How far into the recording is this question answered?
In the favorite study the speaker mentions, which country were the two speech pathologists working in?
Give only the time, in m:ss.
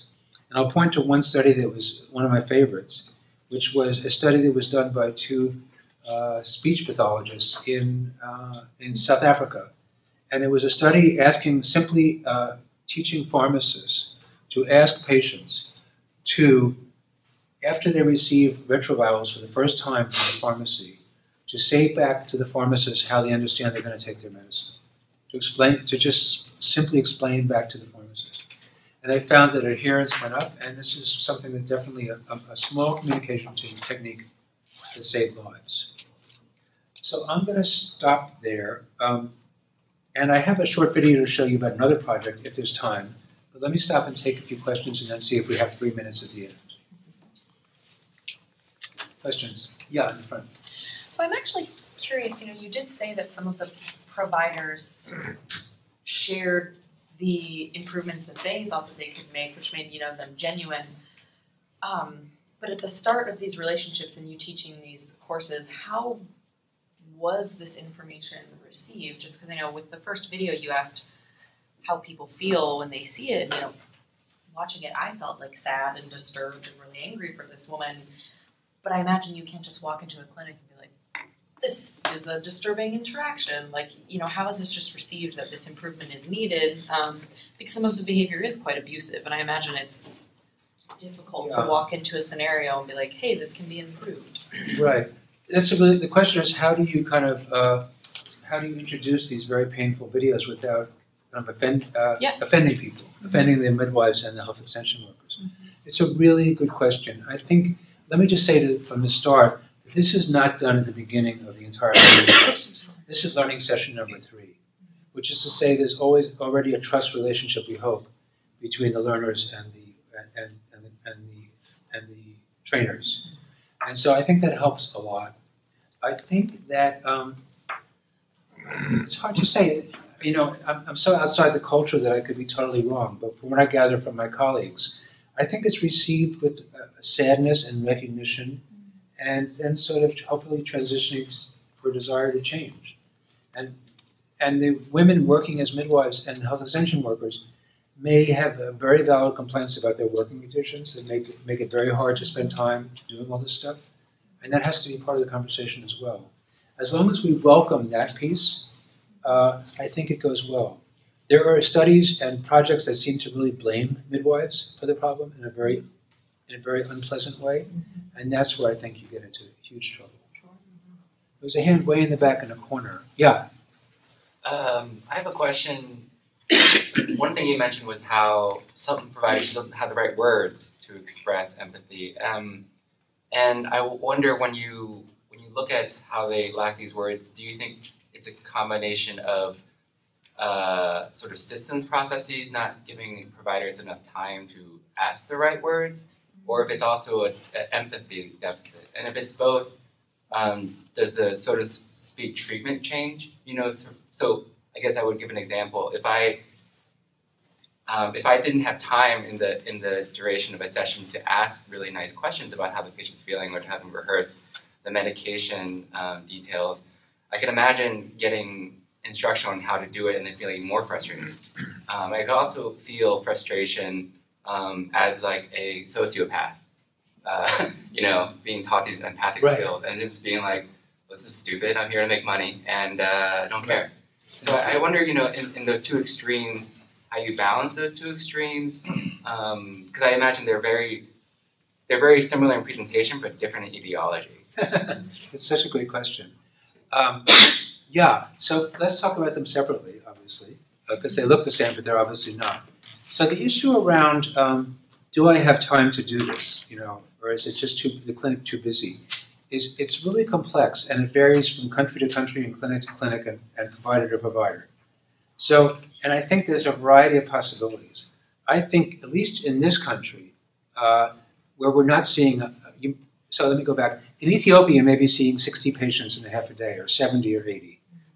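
0:08.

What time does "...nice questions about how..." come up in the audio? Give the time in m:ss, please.
3:31.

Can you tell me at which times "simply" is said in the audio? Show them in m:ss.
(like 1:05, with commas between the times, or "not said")
0:11, 0:26.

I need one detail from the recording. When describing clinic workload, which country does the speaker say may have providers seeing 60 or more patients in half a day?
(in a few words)
Ethiopia.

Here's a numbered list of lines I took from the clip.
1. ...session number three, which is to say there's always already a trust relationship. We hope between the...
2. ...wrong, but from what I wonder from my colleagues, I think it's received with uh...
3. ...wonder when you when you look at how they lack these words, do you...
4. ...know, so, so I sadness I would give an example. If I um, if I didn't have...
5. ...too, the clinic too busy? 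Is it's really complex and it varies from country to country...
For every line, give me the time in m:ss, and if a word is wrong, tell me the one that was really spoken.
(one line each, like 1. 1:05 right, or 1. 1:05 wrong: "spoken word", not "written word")
1. 1:53 right
2. 2:12 wrong: "gather", not "wonder"
3. 3:03 right
4. 3:23 wrong: "guess", not "sadness"
5. 4:17 right.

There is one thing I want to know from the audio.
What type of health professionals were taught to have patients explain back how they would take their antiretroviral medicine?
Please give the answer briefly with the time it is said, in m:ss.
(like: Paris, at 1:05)
pharmacists, at 0:13.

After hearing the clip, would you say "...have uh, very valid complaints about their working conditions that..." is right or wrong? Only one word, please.
right.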